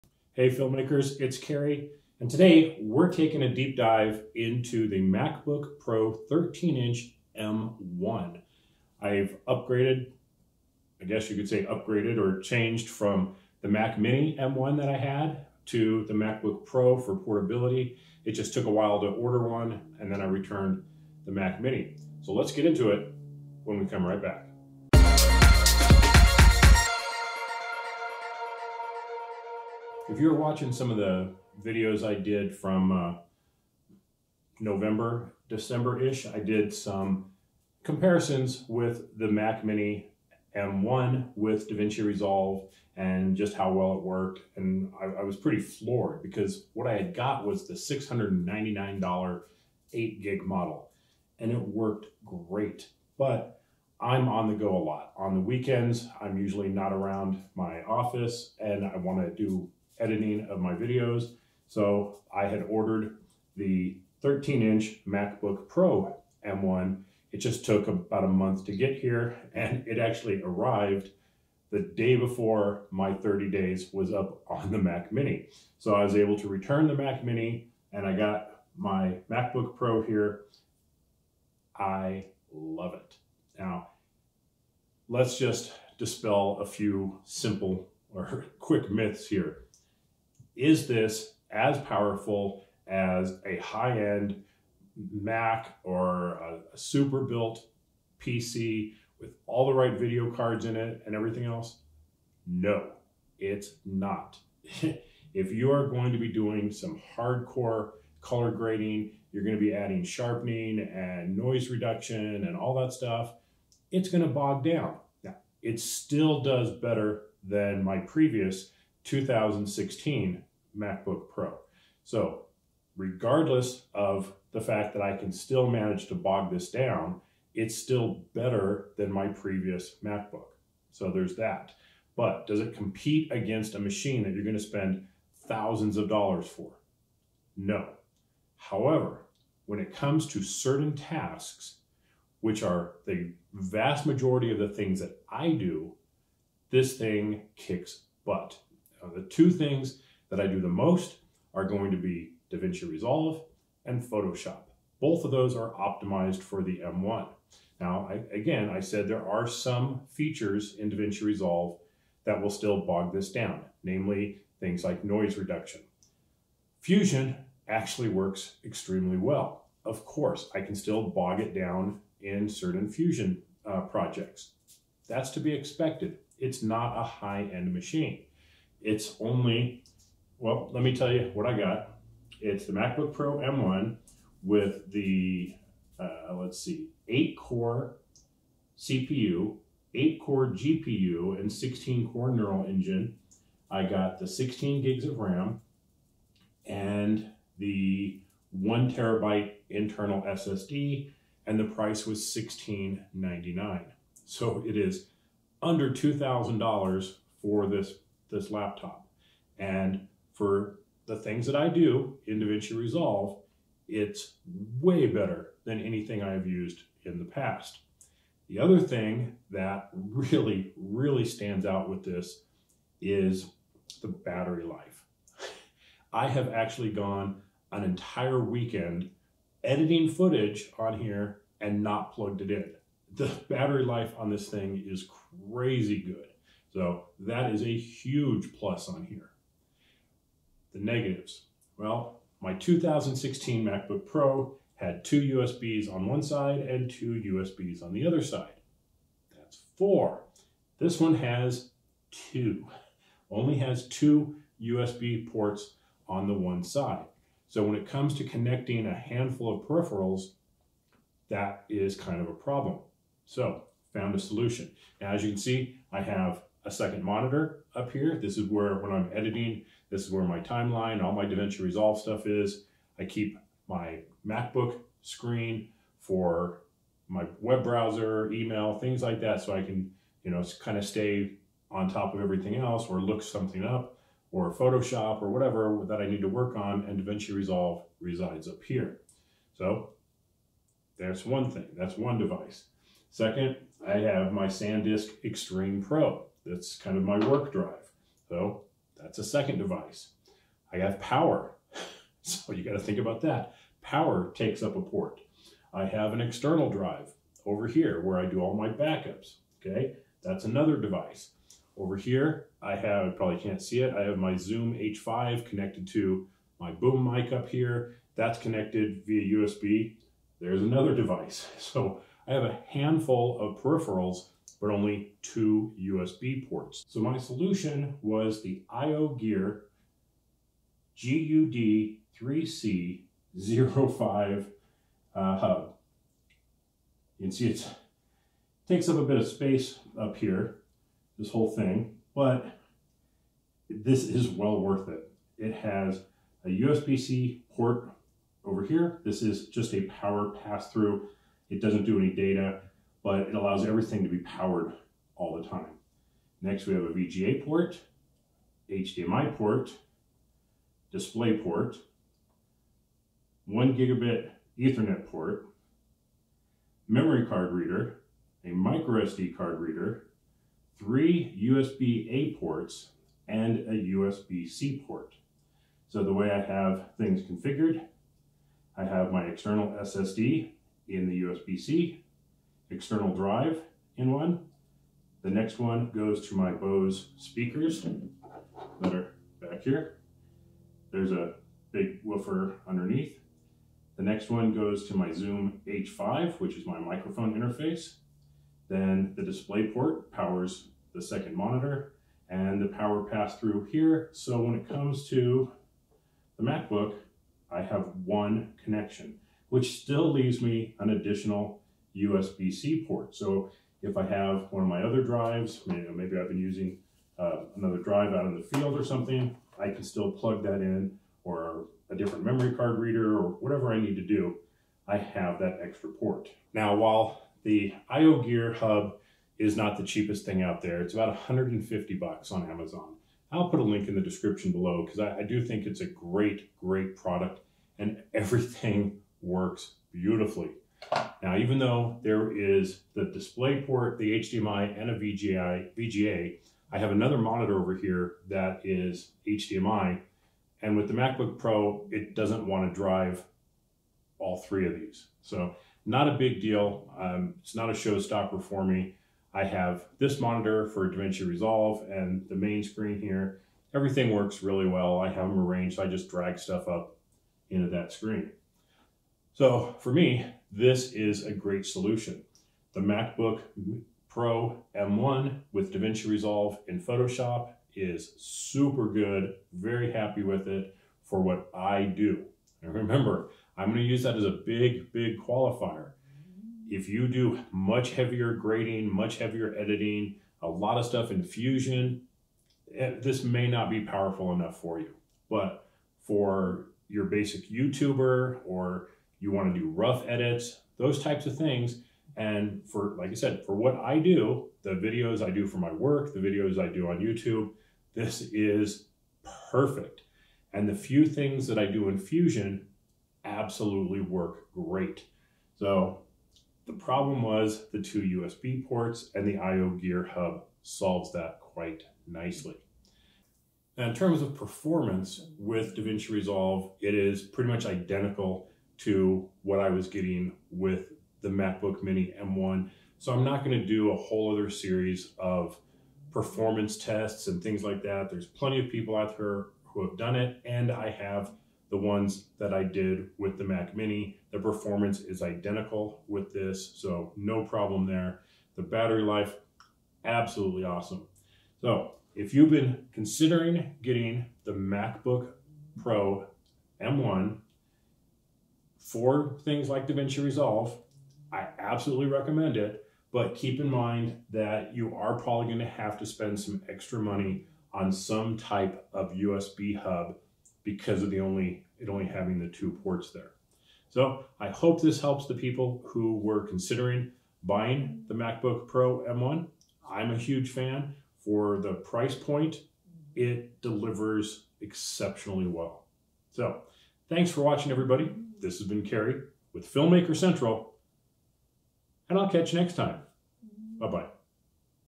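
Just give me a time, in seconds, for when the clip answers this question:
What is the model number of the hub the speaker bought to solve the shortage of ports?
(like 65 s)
330 s.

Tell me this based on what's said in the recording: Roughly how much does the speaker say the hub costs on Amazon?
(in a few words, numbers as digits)
$150.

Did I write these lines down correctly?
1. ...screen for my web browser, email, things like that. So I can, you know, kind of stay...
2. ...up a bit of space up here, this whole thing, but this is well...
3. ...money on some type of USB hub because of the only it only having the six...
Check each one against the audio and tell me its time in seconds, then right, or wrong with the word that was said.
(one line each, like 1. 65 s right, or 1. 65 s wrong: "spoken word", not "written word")
1. 275 s right
2. 338 s right
3. 566 s wrong: "two", not "six".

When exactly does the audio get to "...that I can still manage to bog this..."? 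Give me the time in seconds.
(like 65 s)
124 s.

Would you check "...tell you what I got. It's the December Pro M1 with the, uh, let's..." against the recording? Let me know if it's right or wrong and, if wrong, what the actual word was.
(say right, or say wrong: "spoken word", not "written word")
wrong: "MacBook", not "December".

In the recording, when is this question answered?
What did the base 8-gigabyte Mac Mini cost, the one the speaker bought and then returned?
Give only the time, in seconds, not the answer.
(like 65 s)
47 s.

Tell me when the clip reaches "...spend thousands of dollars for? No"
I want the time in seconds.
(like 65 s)
134 s.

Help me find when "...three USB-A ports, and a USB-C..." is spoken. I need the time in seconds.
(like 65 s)
370 s.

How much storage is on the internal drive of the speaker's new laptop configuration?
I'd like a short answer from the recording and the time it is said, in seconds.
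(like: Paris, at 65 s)
1 terabyte, at 198 s.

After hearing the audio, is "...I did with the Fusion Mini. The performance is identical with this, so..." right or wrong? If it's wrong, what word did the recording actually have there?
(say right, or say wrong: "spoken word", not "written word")
wrong: "Mac", not "Fusion".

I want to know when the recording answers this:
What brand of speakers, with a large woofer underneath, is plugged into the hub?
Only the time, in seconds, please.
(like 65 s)
386 s.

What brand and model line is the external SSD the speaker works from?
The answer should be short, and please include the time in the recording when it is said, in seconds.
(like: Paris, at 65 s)
SanDisk Extreme Pro, at 294 s.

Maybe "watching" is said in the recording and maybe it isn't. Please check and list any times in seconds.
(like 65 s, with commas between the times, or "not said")
30 s, 587 s.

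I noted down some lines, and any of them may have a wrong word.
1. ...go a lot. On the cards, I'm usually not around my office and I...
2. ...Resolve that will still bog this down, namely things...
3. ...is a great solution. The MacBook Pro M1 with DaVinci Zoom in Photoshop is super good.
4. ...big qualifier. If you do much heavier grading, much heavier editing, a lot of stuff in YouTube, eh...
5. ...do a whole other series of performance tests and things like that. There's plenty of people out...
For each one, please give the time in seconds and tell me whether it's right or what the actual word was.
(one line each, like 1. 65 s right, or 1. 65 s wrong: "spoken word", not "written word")
1. 54 s wrong: "weekends", not "cards"
2. 161 s right
3. 470 s wrong: "Resolve", not "Zoom"
4. 484 s wrong: "Fusion", not "YouTube"
5. 533 s right.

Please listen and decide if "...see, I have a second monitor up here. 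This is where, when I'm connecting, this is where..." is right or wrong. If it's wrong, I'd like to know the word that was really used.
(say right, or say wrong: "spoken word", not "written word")
wrong: "editing", not "connecting".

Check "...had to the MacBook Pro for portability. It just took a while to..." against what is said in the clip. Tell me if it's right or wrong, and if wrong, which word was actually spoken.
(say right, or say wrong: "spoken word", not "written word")
right.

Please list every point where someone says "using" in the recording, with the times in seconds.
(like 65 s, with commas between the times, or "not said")
416 s.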